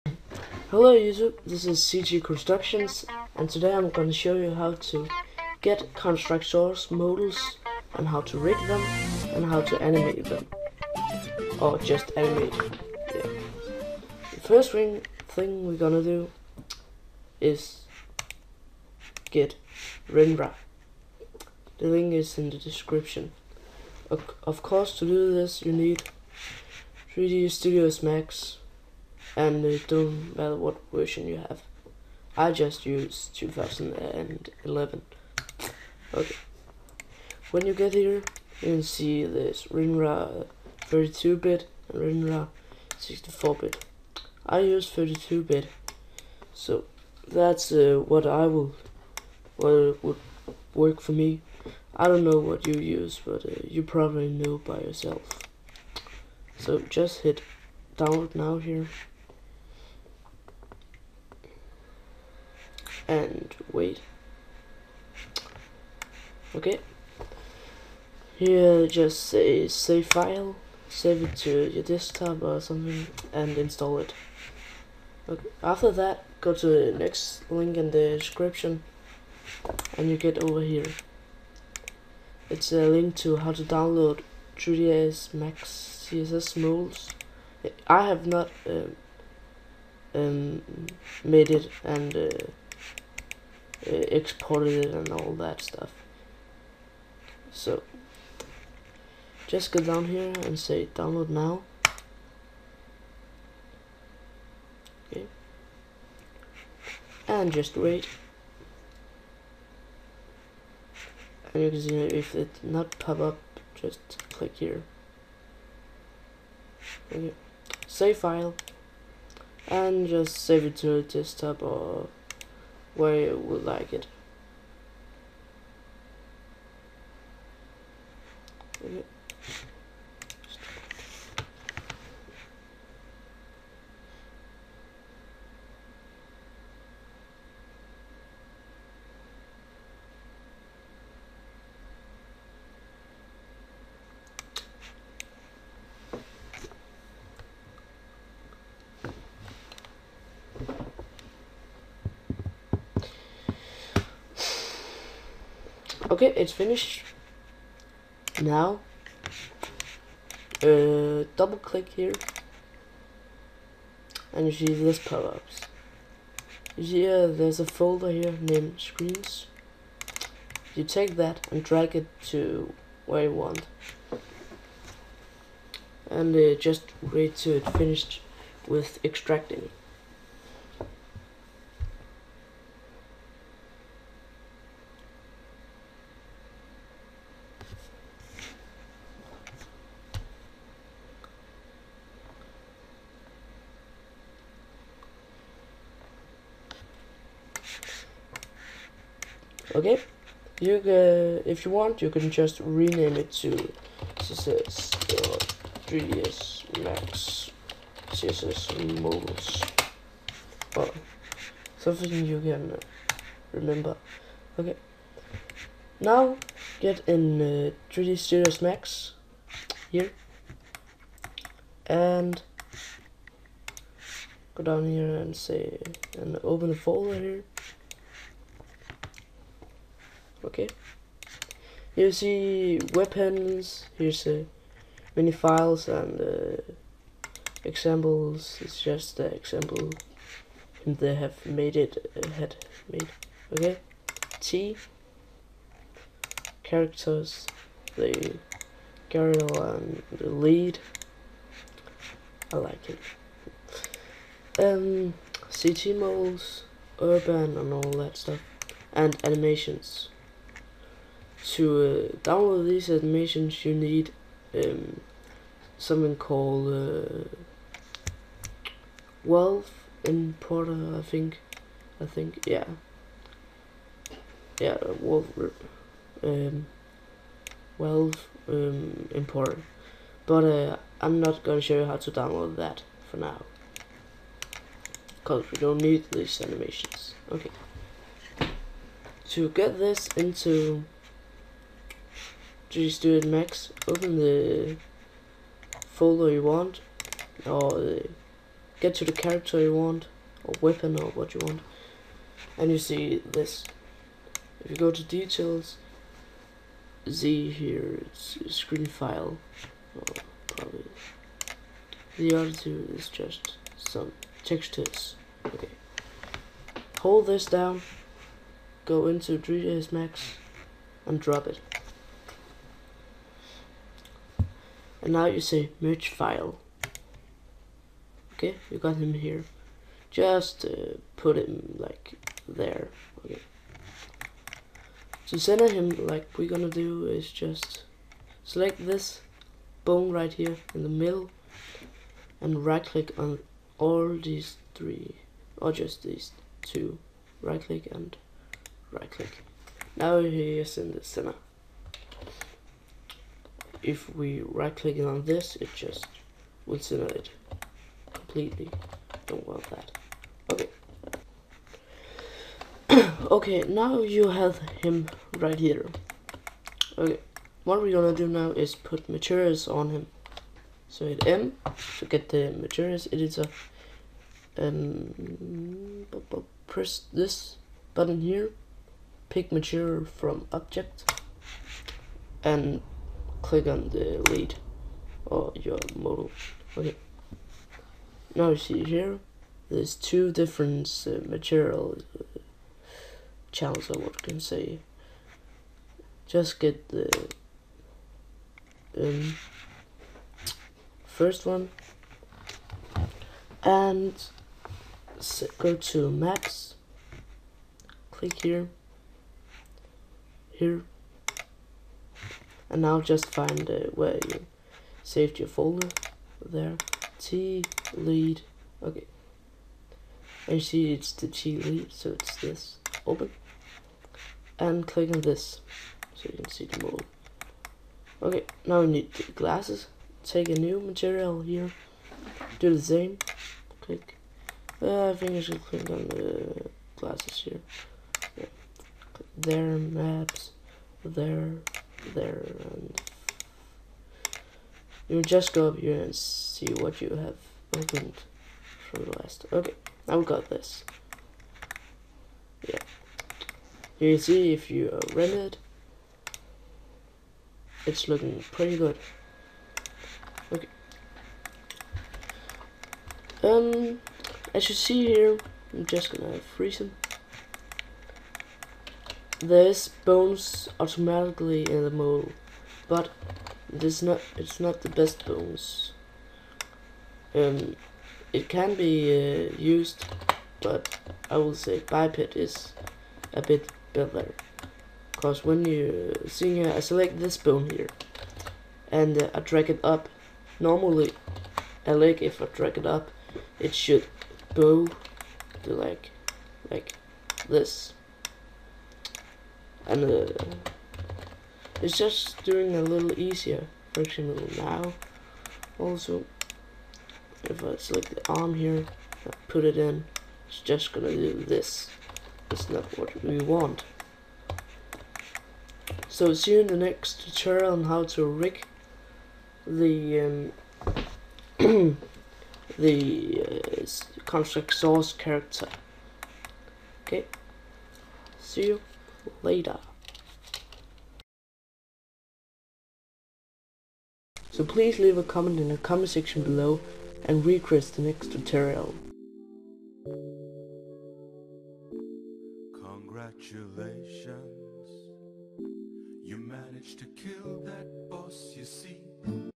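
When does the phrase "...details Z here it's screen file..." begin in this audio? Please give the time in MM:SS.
05:05.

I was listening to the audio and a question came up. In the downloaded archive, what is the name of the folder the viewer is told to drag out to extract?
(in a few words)
screens.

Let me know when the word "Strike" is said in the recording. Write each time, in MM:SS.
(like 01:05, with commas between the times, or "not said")
00:06.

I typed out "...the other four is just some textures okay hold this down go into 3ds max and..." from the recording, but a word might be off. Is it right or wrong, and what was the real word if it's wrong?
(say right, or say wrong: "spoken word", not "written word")
wrong: "two", not "four".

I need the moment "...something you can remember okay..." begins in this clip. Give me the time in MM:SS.
03:31.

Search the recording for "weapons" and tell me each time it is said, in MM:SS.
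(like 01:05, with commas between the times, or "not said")
03:52, 05:00.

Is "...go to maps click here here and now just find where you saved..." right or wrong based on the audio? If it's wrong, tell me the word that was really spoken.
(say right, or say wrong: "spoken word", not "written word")
right.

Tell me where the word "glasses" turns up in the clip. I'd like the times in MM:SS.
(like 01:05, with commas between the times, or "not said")
07:09, 07:16.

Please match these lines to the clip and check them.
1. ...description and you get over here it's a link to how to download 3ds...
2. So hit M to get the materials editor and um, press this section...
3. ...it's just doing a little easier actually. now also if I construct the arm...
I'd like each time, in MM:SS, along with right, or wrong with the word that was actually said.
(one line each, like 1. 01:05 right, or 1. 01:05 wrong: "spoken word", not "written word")
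1. 01:18 right
2. 06:10 wrong: "button", not "section"
3. 08:21 wrong: "select", not "construct".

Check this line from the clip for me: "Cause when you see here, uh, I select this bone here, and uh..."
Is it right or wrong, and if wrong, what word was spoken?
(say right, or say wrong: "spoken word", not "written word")
right.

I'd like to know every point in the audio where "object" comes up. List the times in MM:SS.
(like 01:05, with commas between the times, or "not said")
06:20.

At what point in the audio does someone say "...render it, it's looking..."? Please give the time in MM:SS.
07:35.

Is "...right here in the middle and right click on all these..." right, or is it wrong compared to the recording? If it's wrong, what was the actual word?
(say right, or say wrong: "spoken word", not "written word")
right.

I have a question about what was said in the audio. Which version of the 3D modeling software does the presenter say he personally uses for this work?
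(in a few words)
2011.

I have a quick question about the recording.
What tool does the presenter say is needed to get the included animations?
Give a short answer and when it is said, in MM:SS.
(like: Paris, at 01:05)
Wealth Importer, at 04:29.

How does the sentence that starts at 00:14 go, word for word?
The first thing, thing we're gonna do is get WinRAR.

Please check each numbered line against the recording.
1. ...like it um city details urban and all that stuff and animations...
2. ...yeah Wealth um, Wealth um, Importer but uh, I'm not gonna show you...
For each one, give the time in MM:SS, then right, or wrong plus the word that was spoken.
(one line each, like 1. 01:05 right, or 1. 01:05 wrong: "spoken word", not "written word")
1. 04:12 wrong: "models", not "details"
2. 04:34 right.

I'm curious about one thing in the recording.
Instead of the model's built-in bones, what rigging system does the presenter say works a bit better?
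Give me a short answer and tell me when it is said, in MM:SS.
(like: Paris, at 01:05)
biped, at 08:01.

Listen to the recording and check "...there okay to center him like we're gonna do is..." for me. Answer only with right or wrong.
right.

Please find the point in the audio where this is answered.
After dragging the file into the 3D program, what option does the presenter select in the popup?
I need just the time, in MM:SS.
05:25.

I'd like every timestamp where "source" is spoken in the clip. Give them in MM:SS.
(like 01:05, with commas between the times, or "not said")
00:06, 08:44.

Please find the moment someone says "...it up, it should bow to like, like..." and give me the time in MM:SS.
08:12.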